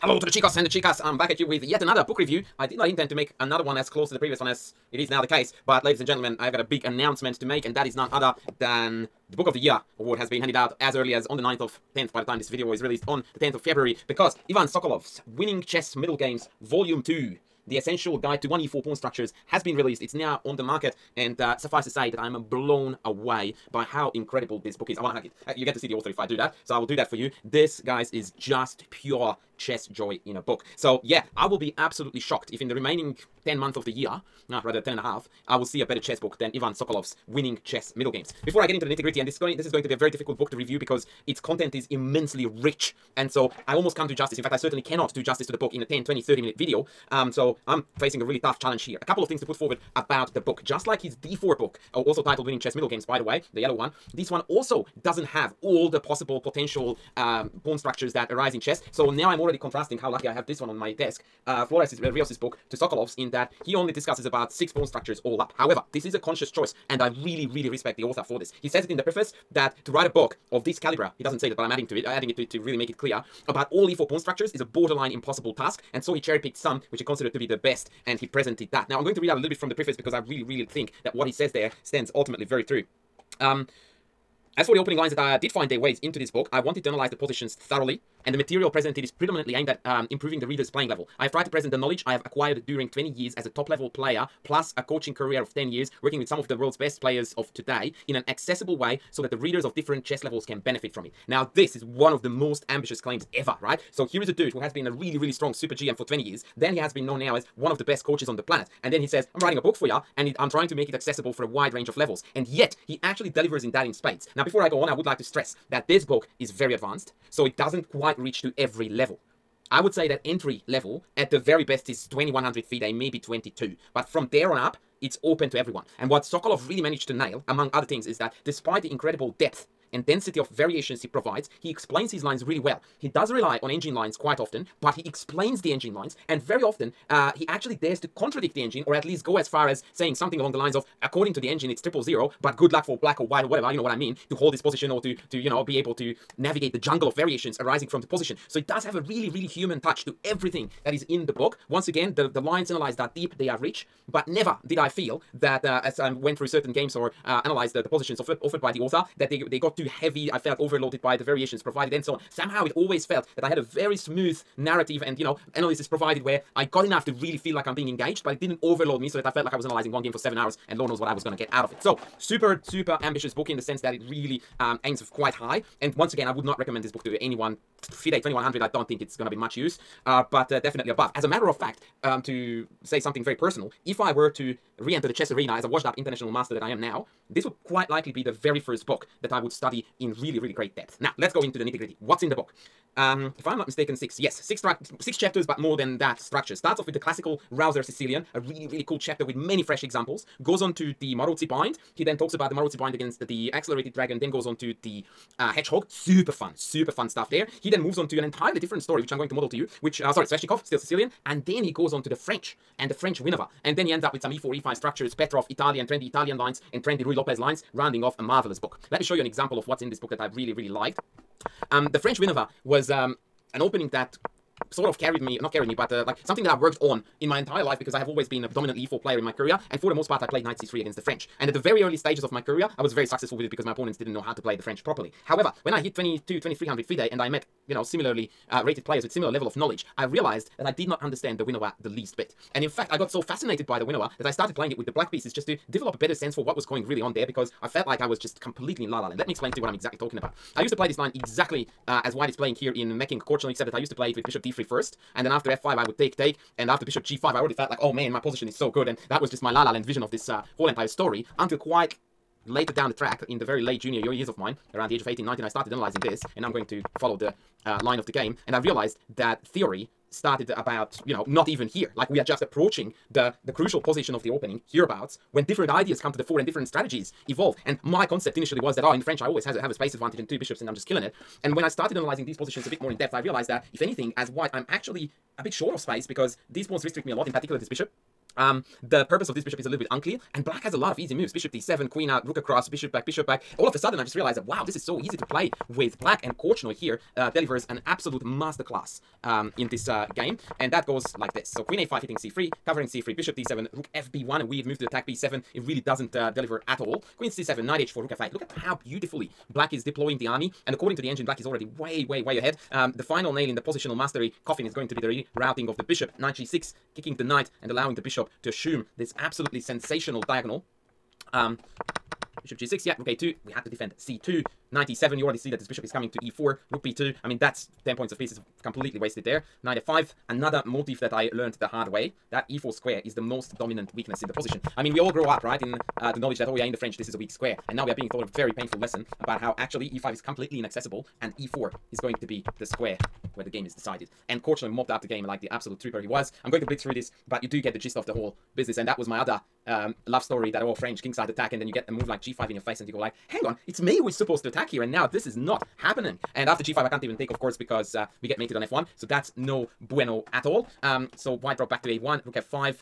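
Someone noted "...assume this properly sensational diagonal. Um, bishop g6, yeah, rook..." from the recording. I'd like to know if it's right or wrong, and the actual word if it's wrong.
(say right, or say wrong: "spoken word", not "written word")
wrong: "absolutely", not "properly".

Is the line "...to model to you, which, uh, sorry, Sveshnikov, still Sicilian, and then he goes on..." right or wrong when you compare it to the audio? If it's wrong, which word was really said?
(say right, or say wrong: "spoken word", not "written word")
right.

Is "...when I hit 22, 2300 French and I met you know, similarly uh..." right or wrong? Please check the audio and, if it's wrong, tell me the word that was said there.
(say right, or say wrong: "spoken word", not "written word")
wrong: "FIDE", not "French".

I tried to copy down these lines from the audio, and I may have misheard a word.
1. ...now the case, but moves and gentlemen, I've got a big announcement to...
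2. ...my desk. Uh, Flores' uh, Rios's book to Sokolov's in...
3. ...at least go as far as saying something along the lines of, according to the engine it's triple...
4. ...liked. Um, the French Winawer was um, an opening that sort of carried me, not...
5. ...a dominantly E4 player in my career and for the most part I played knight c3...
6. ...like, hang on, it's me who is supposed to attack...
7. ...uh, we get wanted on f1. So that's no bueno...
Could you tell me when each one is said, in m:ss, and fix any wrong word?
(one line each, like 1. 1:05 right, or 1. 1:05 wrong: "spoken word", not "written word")
1. 0:05 wrong: "ladies", not "moves"
2. 1:00 right
3. 2:18 right
4. 3:40 right
5. 3:48 right
6. 5:52 right
7. 5:57 wrong: "mated", not "wanted".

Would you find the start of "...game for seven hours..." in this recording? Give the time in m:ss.
2:50.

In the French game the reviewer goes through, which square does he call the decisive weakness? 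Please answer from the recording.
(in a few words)
e4.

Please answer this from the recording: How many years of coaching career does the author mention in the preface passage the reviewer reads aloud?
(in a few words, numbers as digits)
10.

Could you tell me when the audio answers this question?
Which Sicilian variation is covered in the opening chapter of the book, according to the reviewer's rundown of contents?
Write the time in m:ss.
3:16.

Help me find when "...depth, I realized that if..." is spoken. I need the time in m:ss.
4:42.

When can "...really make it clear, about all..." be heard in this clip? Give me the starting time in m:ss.
1:12.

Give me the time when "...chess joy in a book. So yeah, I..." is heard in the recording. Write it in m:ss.
0:29.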